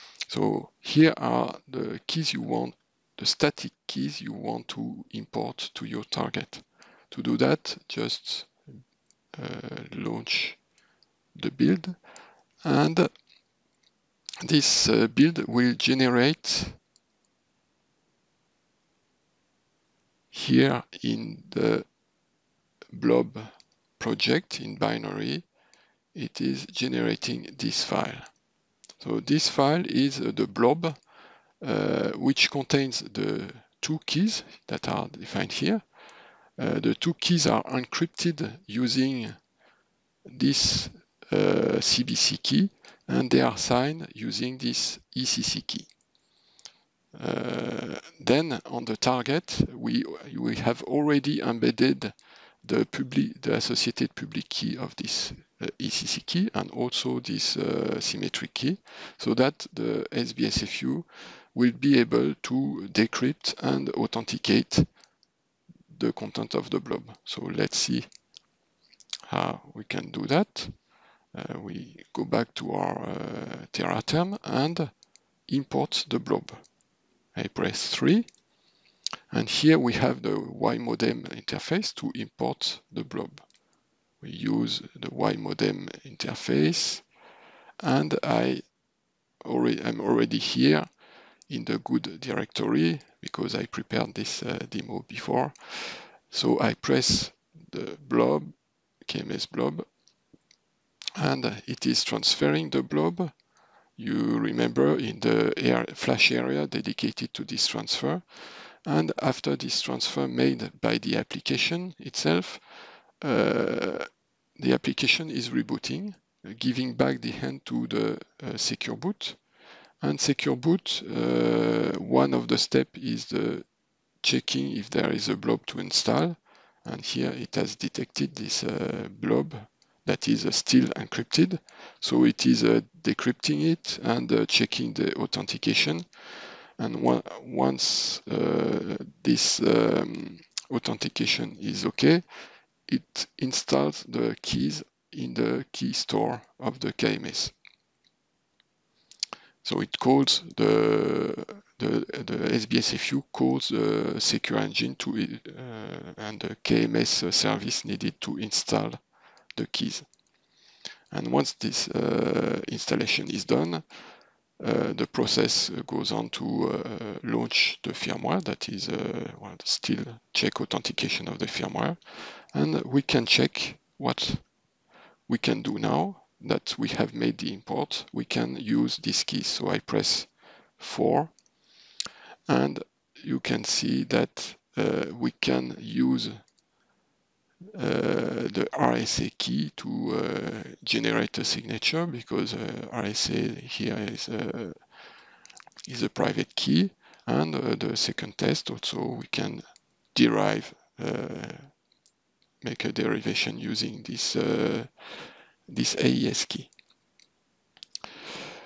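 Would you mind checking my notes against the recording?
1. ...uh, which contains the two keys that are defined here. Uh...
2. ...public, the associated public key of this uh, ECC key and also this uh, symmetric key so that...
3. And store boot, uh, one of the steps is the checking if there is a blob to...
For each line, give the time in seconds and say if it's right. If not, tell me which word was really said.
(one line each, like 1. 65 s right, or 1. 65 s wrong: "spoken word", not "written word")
1. 31 s right
2. 52 s right
3. 120 s wrong: "secure", not "store".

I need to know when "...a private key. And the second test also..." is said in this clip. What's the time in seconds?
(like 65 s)
196 s.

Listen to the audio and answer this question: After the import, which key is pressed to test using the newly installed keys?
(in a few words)
4.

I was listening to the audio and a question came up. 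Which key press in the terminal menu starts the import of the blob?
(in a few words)
3.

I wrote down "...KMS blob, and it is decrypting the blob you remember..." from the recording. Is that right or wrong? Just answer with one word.
wrong.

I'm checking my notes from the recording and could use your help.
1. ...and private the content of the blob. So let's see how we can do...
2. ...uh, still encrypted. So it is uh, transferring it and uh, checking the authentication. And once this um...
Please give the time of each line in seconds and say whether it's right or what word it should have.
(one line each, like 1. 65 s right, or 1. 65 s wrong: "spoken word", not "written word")
1. 63 s wrong: "authenticate", not "private"
2. 130 s wrong: "decrypting", not "transferring".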